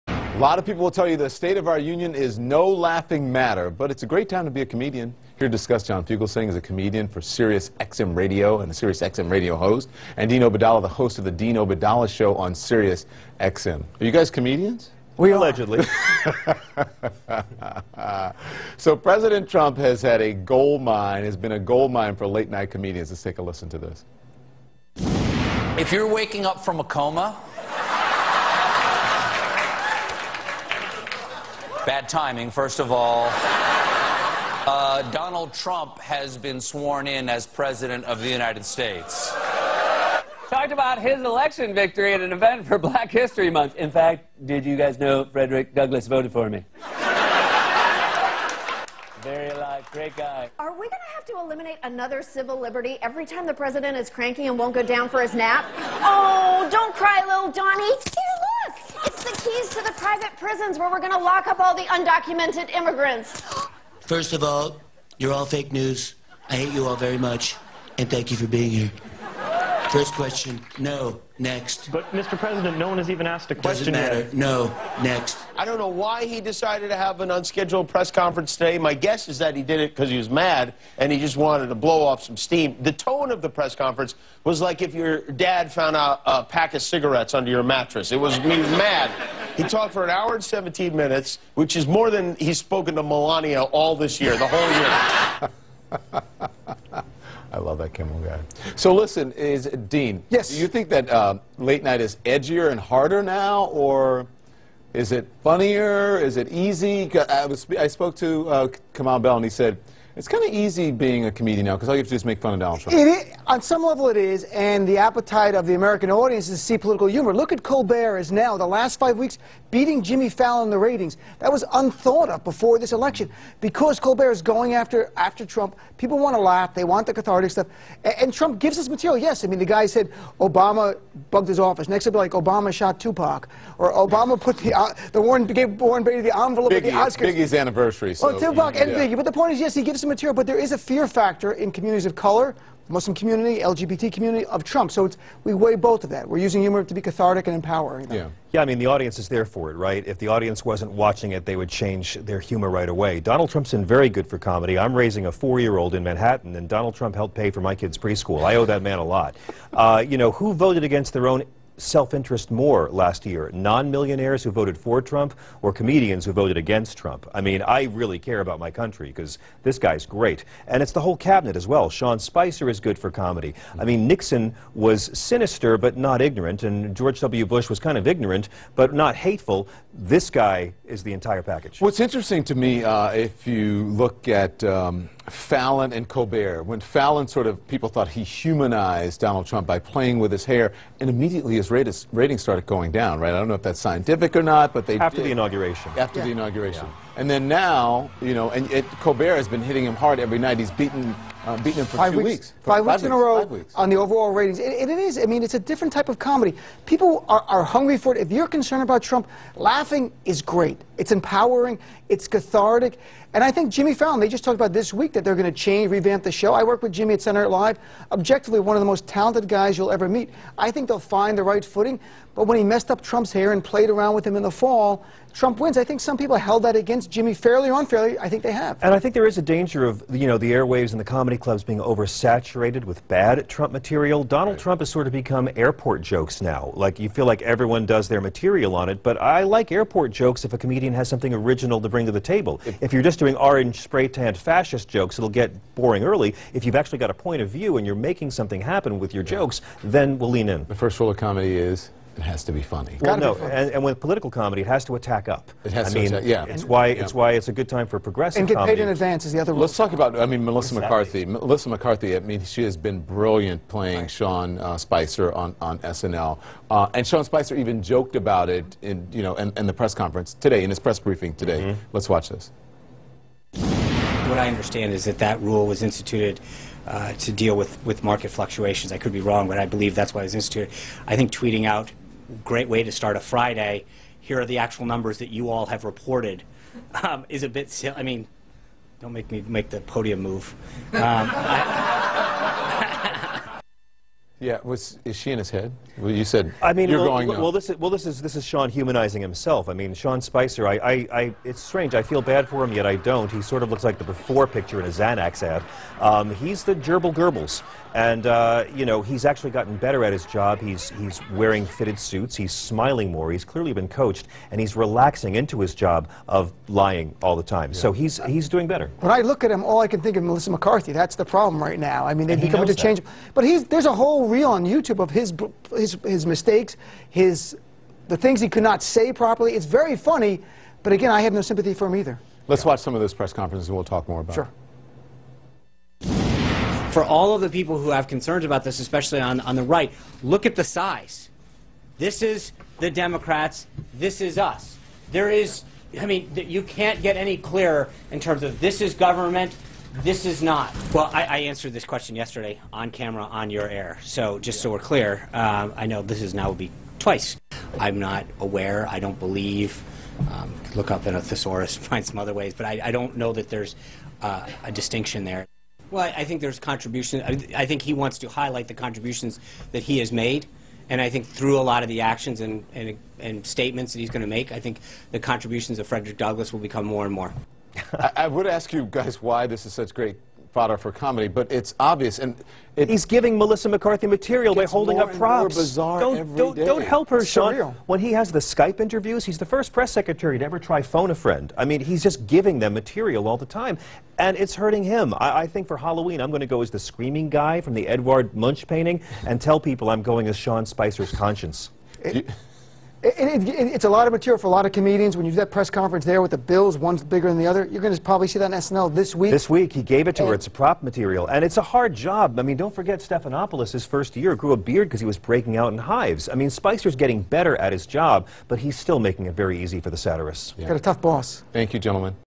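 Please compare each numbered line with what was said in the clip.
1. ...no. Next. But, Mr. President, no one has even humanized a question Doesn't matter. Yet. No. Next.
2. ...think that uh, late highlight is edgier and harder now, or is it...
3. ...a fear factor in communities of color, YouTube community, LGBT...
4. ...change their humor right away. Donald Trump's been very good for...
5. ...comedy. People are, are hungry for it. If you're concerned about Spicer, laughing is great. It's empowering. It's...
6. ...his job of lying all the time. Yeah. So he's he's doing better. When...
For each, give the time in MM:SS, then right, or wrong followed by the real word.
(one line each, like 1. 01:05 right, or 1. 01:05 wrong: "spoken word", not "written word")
1. 01:10 wrong: "asked", not "humanized"
2. 01:40 wrong: "night", not "highlight"
3. 02:20 wrong: "Muslim", not "YouTube"
4. 02:31 right
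5. 03:26 wrong: "Trump", not "Spicer"
6. 05:15 right.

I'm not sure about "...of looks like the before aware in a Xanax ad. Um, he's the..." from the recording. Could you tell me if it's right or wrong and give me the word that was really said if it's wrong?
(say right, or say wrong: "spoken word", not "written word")
wrong: "picture", not "aware".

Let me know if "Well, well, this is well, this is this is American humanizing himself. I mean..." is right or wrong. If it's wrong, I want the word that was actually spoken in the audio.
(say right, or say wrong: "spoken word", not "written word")
wrong: "Sean", not "American".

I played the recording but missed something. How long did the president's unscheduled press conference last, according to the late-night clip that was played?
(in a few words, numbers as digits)
1 hour and 17 minutes.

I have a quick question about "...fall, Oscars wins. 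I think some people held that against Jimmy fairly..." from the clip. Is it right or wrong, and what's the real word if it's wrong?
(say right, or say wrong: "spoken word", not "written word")
wrong: "Trump", not "Oscars".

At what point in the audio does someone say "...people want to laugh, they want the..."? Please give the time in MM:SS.
02:05.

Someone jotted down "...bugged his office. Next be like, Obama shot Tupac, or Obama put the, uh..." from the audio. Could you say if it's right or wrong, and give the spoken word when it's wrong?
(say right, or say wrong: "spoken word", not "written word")
right.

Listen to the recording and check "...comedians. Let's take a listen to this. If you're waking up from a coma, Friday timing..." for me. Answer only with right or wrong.
wrong.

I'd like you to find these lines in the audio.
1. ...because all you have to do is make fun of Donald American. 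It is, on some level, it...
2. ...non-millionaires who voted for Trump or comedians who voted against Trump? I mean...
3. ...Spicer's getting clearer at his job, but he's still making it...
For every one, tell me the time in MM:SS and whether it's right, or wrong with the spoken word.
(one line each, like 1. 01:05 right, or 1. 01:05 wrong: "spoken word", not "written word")
1. 01:51 wrong: "Trump", not "American"
2. 02:43 right
3. 06:56 wrong: "better", not "clearer".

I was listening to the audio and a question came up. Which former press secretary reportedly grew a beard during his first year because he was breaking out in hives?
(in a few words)
Stephanopoulos.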